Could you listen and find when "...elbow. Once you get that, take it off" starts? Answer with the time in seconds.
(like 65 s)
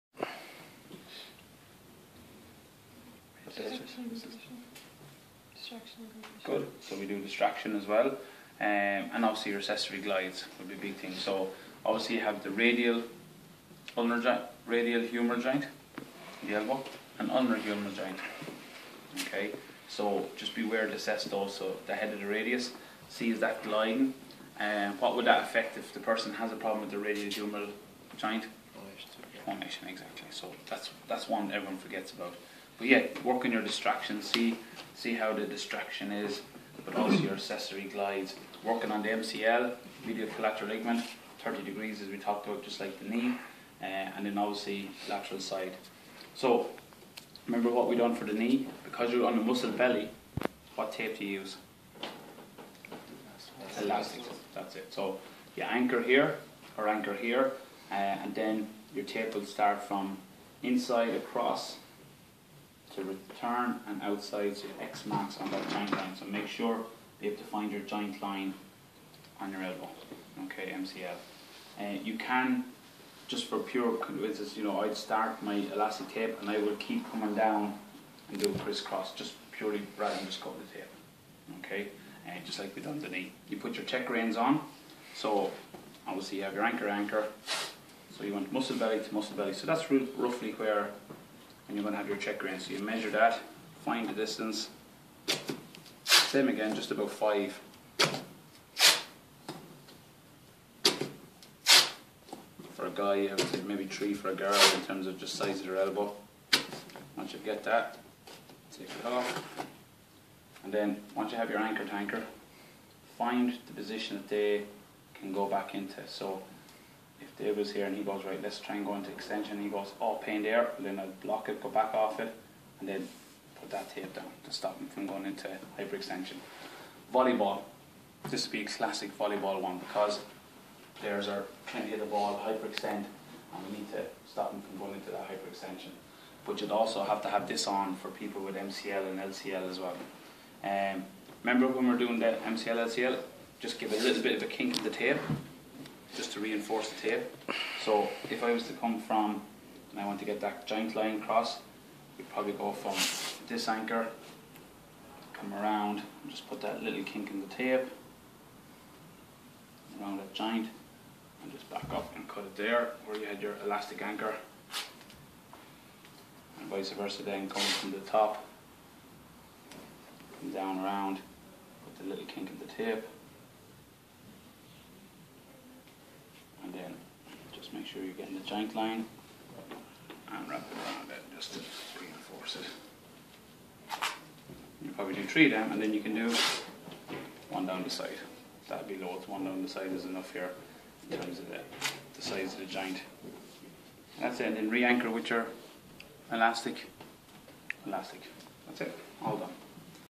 105 s.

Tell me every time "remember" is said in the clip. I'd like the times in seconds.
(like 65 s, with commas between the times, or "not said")
47 s, 141 s.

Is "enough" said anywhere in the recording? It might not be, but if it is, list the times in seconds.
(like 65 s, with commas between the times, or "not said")
190 s.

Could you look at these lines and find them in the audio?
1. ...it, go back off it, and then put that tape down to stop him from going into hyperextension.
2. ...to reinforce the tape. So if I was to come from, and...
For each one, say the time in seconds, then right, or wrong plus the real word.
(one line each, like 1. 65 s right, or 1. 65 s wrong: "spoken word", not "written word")
1. 121 s right
2. 146 s right.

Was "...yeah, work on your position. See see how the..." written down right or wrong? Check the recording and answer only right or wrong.
wrong.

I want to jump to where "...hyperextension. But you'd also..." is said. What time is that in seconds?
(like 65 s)
135 s.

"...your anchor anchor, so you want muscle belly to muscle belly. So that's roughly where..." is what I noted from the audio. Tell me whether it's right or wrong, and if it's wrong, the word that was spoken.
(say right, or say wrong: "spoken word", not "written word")
right.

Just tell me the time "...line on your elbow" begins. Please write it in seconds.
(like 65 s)
68 s.